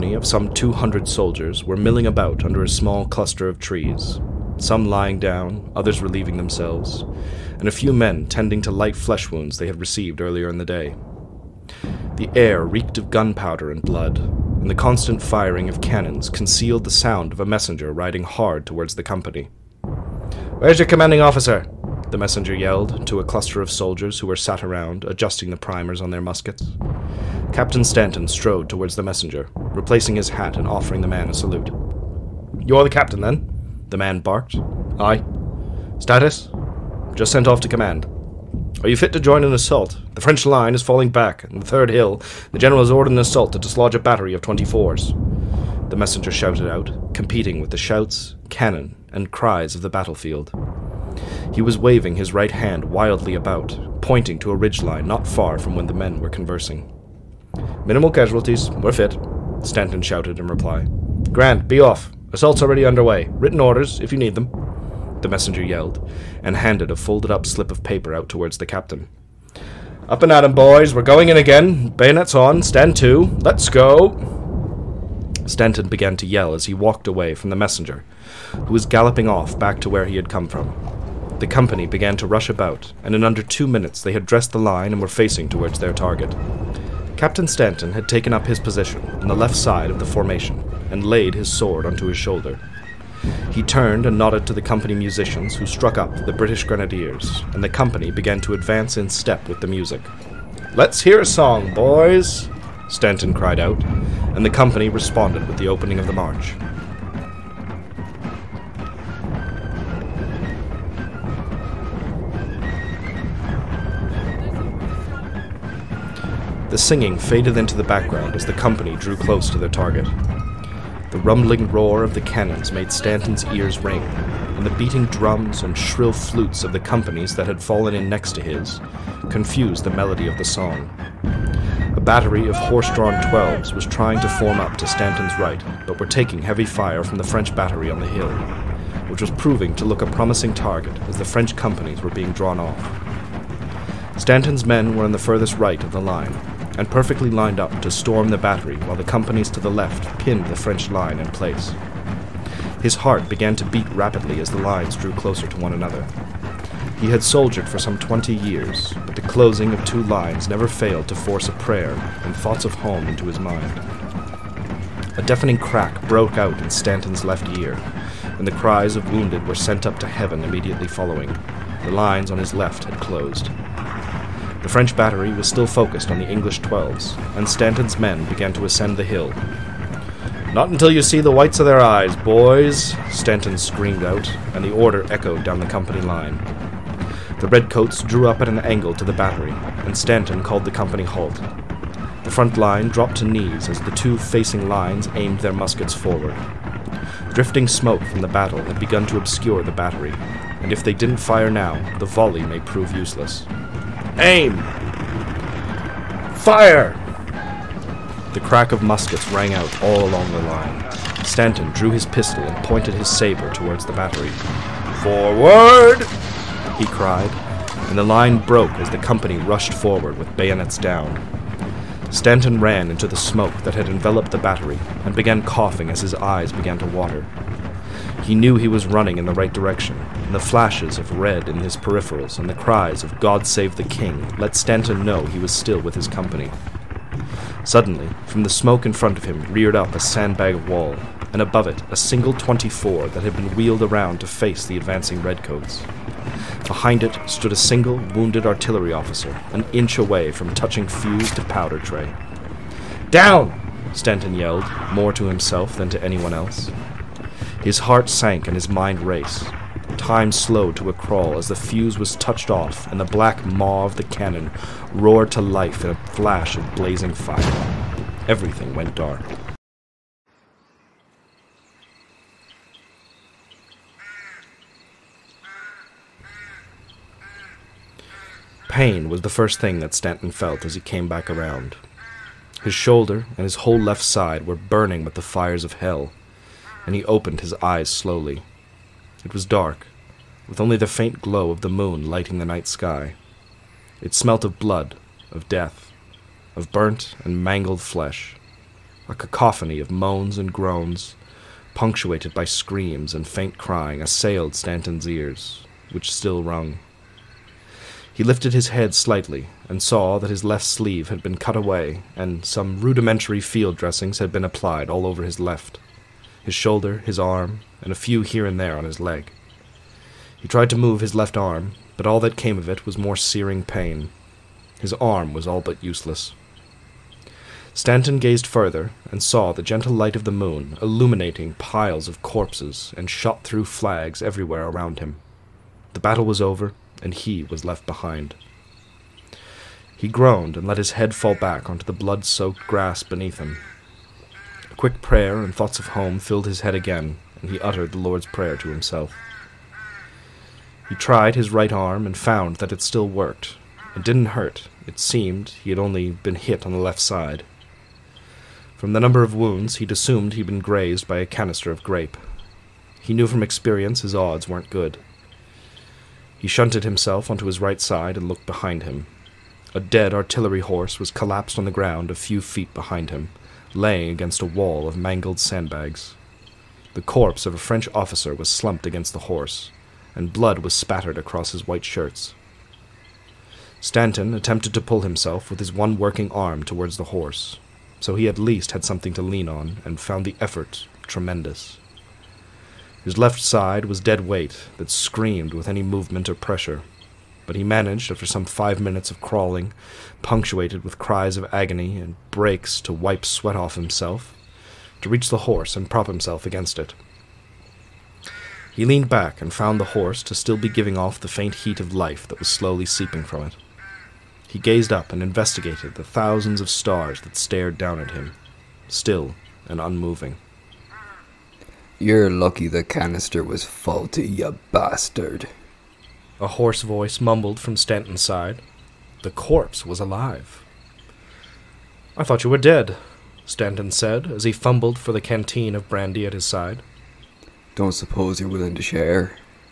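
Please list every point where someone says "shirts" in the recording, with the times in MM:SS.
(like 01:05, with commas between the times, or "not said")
06:21.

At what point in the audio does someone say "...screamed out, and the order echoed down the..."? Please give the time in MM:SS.
03:03.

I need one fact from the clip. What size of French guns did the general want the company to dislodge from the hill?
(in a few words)
24s.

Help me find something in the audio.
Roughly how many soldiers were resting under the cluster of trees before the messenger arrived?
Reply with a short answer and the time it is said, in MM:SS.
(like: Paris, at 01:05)
200, at 00:00.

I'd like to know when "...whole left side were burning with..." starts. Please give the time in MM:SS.
04:43.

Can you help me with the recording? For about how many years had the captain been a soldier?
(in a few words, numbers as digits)
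20.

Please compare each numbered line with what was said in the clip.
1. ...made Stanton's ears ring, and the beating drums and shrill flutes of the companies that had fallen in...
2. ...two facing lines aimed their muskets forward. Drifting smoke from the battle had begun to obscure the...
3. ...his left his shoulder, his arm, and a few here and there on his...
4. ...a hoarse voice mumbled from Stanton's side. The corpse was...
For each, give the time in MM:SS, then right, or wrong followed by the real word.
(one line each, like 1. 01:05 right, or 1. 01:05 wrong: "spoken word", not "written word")
1. 02:02 right
2. 03:13 right
3. 05:15 right
4. 07:06 right.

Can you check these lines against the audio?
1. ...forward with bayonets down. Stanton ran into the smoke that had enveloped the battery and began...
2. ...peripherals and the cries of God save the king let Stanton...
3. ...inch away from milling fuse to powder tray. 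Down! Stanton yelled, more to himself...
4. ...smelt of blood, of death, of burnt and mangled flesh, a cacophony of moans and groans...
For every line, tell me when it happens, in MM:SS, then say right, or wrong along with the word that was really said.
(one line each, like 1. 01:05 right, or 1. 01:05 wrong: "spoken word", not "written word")
1. 03:39 right
2. 03:51 right
3. 04:09 wrong: "touching", not "milling"
4. 04:54 right.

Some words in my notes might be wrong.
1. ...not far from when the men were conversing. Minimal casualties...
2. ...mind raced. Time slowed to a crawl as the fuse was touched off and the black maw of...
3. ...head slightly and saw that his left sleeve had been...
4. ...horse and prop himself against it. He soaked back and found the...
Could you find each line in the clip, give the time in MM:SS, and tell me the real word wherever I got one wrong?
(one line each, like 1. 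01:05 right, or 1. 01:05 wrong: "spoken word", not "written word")
1. 00:55 right
2. 04:18 right
3. 05:08 right
4. 06:45 wrong: "leaned", not "soaked".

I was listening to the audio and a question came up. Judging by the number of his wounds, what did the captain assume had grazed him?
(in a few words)
canister of grape.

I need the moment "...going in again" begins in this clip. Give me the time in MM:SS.
01:11.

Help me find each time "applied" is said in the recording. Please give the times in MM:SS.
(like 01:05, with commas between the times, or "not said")
05:14.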